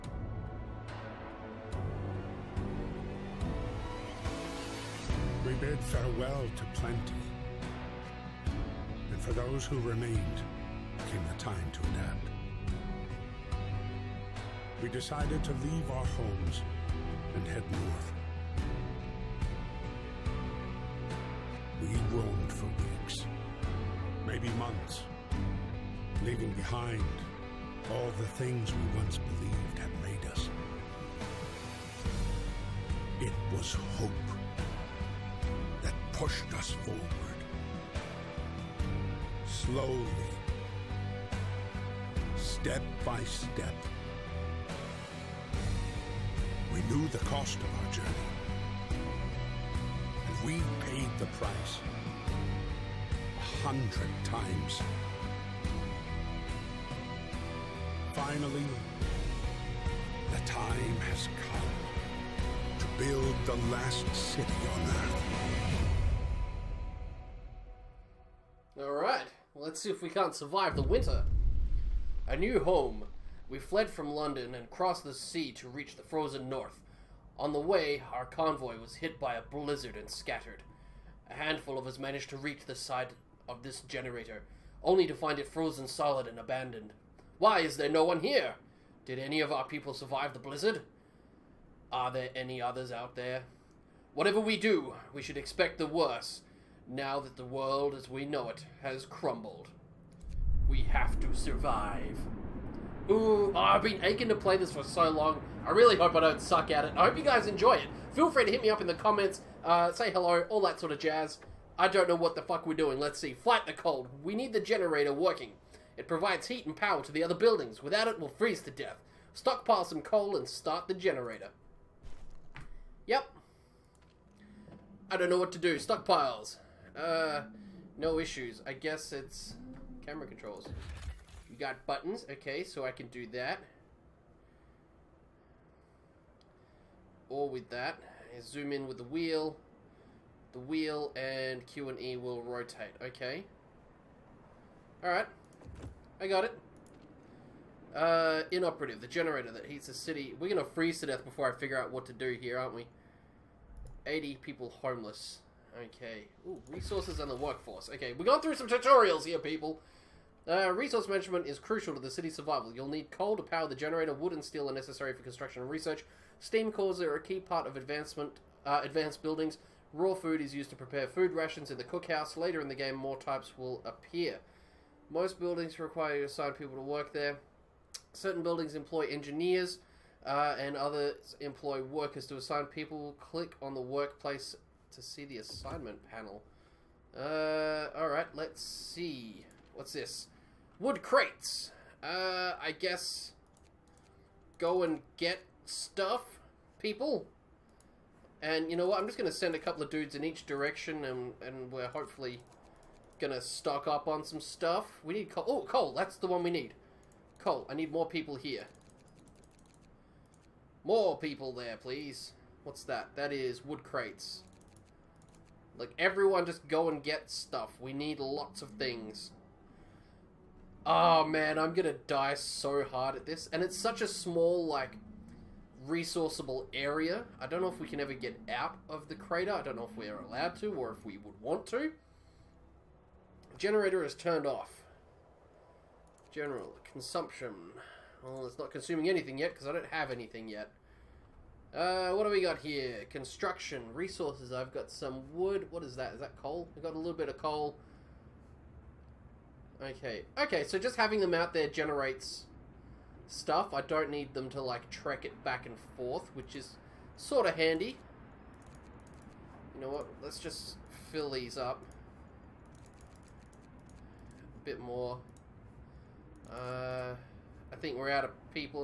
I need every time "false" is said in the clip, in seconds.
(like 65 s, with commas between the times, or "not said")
not said.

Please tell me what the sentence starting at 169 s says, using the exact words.
Raw food is used to prepare food rations in the cookhouse.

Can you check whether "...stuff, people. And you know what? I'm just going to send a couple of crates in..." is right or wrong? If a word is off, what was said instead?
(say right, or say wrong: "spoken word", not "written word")
wrong: "dudes", not "crates".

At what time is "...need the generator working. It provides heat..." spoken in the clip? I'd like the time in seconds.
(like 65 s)
114 s.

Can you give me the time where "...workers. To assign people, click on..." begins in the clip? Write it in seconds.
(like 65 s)
181 s.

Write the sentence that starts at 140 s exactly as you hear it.
The wheel and Q and E will rotate.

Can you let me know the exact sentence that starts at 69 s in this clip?
Let's see if we can't survive the winter.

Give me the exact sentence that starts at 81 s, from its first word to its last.
A handful of us managed to reach the side of this generator, only to find it frozen solid and abandoned.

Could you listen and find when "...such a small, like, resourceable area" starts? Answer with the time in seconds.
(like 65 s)
223 s.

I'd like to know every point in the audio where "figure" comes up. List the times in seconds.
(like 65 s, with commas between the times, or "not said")
151 s.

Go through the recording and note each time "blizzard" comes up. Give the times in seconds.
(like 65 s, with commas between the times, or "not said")
79 s, 90 s.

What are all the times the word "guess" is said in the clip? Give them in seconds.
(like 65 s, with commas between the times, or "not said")
128 s, 192 s.